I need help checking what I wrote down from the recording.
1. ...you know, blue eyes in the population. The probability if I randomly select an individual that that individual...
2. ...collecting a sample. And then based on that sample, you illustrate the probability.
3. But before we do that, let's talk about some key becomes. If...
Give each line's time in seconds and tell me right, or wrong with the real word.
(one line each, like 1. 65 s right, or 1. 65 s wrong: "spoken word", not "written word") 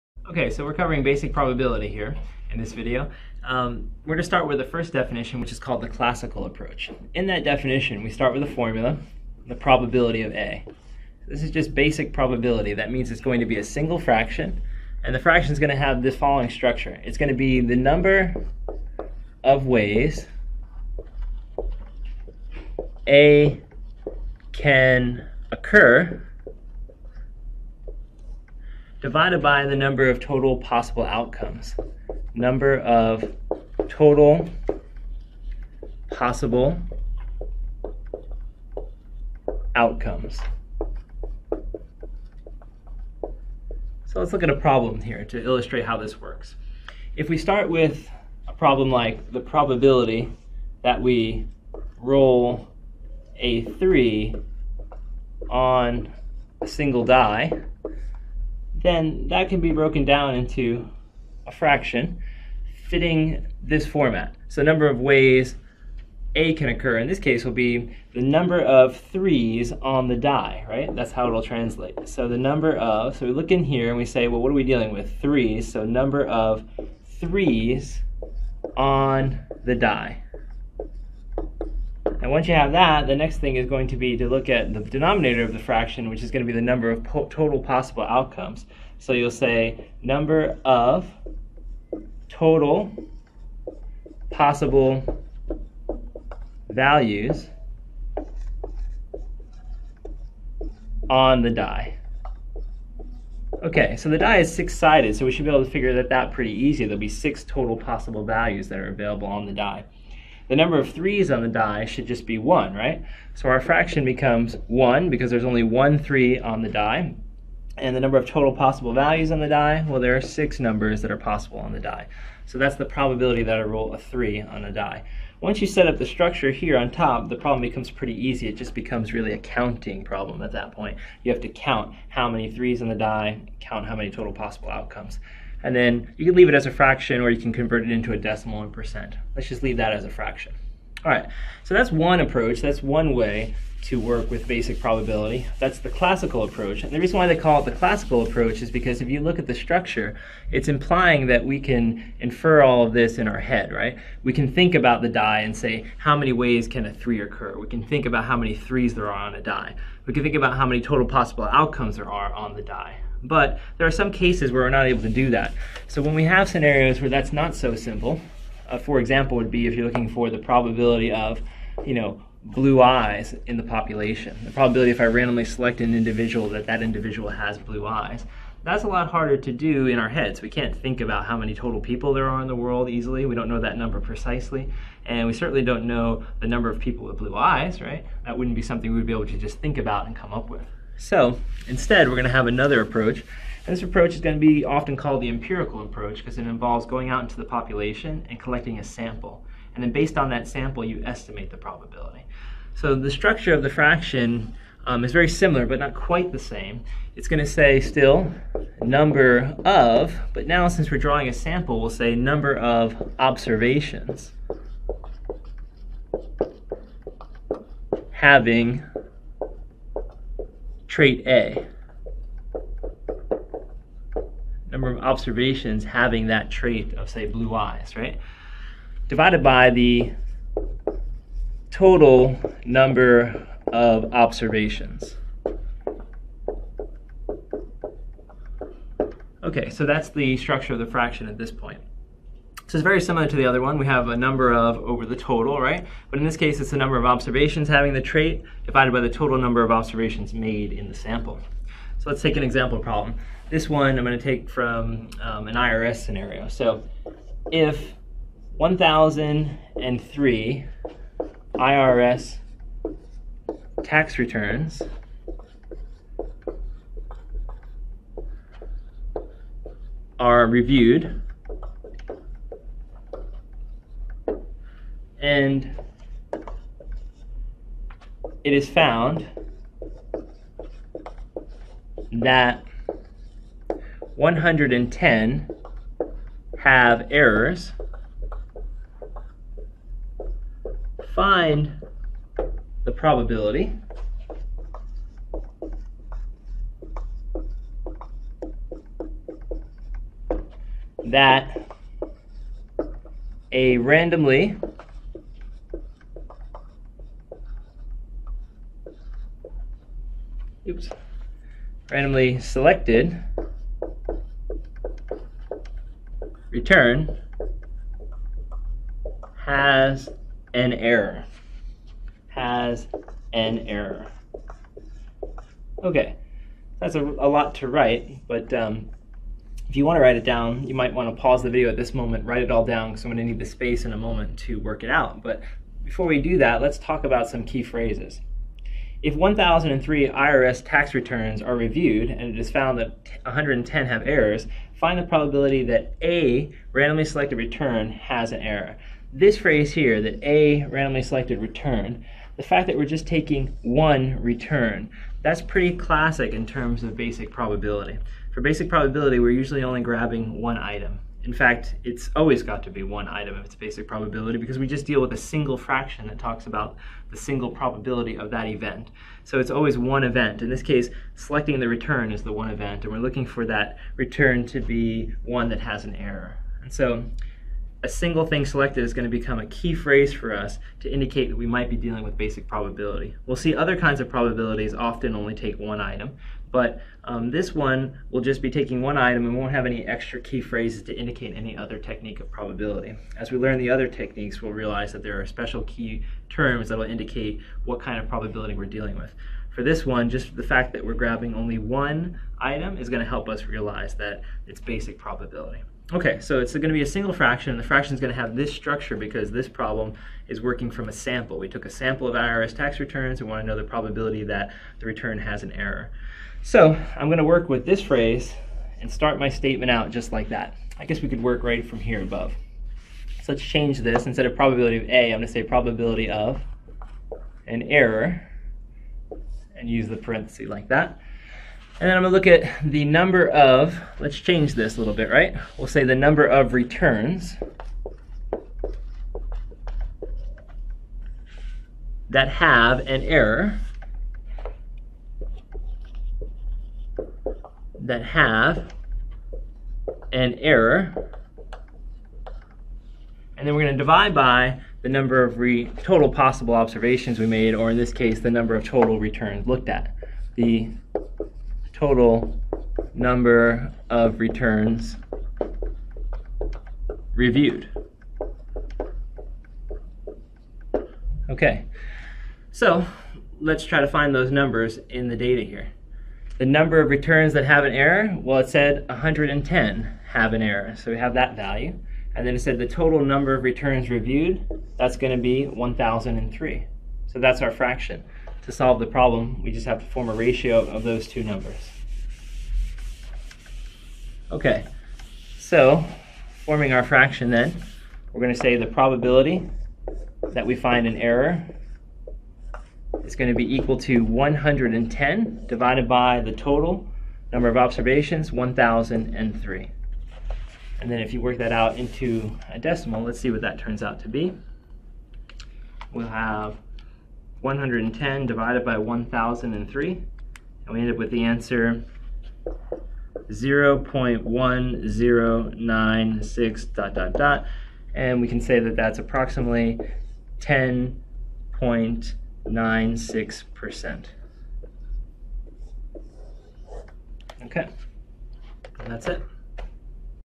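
1. 171 s right
2. 198 s wrong: "estimate", not "illustrate"
3. 335 s wrong: "phrases", not "becomes".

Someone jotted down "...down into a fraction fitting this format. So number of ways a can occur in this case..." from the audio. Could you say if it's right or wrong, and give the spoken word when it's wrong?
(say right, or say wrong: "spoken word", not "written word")
right.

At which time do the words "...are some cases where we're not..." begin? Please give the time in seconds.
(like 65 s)
163 s.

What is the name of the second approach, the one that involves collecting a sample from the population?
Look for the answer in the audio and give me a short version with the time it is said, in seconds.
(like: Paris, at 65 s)
empirical approach, at 195 s.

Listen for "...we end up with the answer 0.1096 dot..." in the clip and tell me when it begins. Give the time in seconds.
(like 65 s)
520 s.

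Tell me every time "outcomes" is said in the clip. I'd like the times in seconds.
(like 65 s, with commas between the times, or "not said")
31 s, 39 s, 88 s, 134 s, 161 s.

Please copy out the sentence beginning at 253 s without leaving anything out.
This one I'm going to take from um, an IRS scenario.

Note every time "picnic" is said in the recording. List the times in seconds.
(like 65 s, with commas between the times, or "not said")
not said.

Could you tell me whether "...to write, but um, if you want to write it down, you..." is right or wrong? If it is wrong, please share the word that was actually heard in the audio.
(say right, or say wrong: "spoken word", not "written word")
right.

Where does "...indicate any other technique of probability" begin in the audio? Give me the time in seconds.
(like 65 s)
390 s.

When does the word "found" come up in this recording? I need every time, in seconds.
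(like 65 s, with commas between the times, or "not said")
278 s, 342 s.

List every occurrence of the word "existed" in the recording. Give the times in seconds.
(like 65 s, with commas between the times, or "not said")
not said.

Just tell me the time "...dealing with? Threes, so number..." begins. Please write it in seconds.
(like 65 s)
74 s.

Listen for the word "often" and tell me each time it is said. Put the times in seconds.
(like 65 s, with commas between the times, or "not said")
194 s, 384 s.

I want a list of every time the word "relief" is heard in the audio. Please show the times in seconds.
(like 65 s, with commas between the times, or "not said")
not said.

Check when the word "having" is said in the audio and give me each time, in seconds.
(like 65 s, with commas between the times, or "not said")
218 s, 225 s, 247 s.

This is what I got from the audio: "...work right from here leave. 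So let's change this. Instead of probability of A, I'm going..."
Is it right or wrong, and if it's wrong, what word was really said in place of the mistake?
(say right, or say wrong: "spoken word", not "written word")
wrong: "above", not "leave".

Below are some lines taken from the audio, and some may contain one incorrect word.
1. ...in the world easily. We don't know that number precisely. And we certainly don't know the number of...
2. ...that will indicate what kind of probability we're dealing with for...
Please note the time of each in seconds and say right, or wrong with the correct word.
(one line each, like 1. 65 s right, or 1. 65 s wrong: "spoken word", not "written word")
1. 182 s right
2. 396 s right.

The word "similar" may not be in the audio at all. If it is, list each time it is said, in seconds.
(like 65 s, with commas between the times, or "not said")
205 s, 243 s.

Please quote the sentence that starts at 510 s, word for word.
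And then if you work that out into a decimal, let's see what that turns out to be.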